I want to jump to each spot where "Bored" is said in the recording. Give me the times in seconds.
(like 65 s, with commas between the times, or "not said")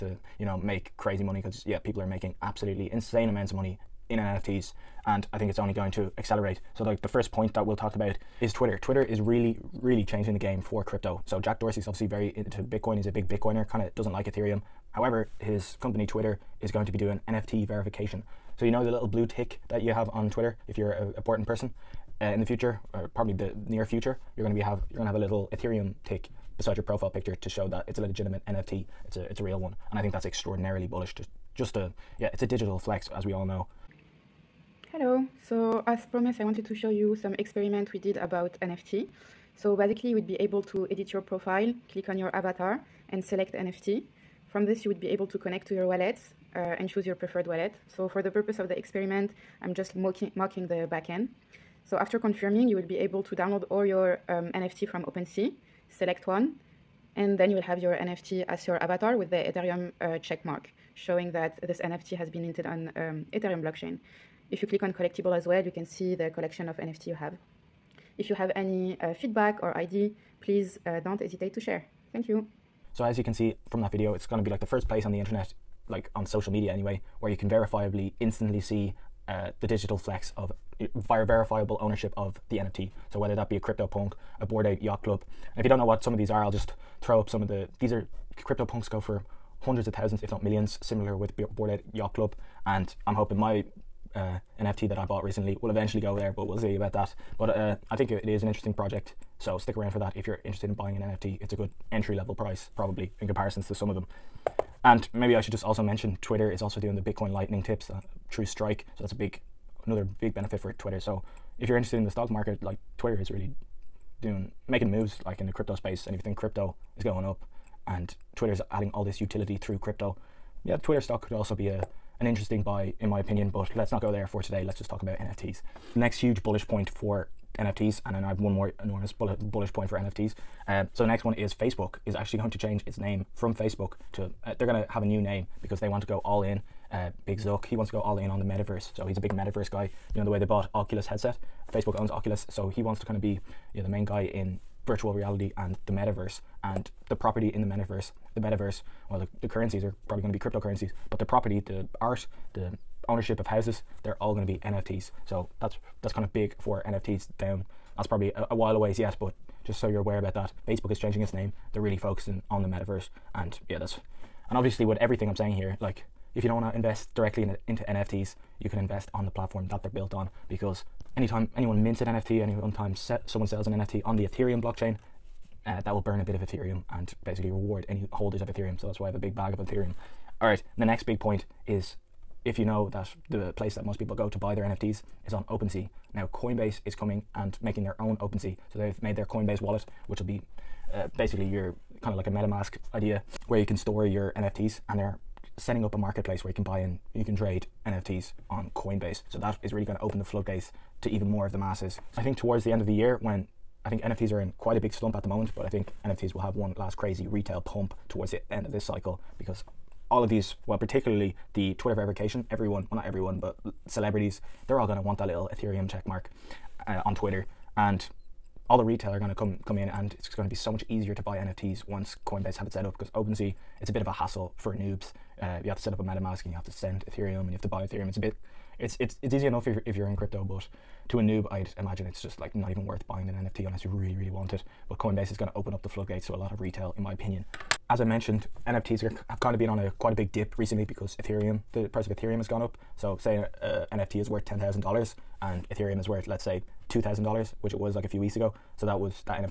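84 s, 91 s.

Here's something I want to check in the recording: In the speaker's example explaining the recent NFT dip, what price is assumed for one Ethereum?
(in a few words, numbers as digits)
$2,000.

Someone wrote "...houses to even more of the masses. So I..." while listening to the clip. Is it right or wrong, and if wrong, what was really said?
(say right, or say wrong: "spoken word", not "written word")
wrong: "floodgates", not "houses".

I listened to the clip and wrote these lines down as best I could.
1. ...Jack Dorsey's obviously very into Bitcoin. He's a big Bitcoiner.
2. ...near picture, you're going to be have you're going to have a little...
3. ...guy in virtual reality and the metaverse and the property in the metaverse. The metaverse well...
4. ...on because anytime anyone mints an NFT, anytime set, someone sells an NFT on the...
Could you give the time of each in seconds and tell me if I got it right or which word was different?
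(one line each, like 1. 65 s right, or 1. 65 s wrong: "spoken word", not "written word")
1. 11 s right
2. 23 s wrong: "future", not "picture"
3. 144 s right
4. 170 s right.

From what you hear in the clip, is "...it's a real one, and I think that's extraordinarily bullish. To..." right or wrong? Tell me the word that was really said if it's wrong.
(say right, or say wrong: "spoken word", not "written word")
right.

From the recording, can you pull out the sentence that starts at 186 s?
Now, Coinbase is coming and making their own OpenSea.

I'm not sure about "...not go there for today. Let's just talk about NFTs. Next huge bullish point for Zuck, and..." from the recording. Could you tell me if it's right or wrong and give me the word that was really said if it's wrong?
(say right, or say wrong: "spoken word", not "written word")
wrong: "NFTs", not "Zuck".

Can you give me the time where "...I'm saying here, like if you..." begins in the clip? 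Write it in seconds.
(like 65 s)
165 s.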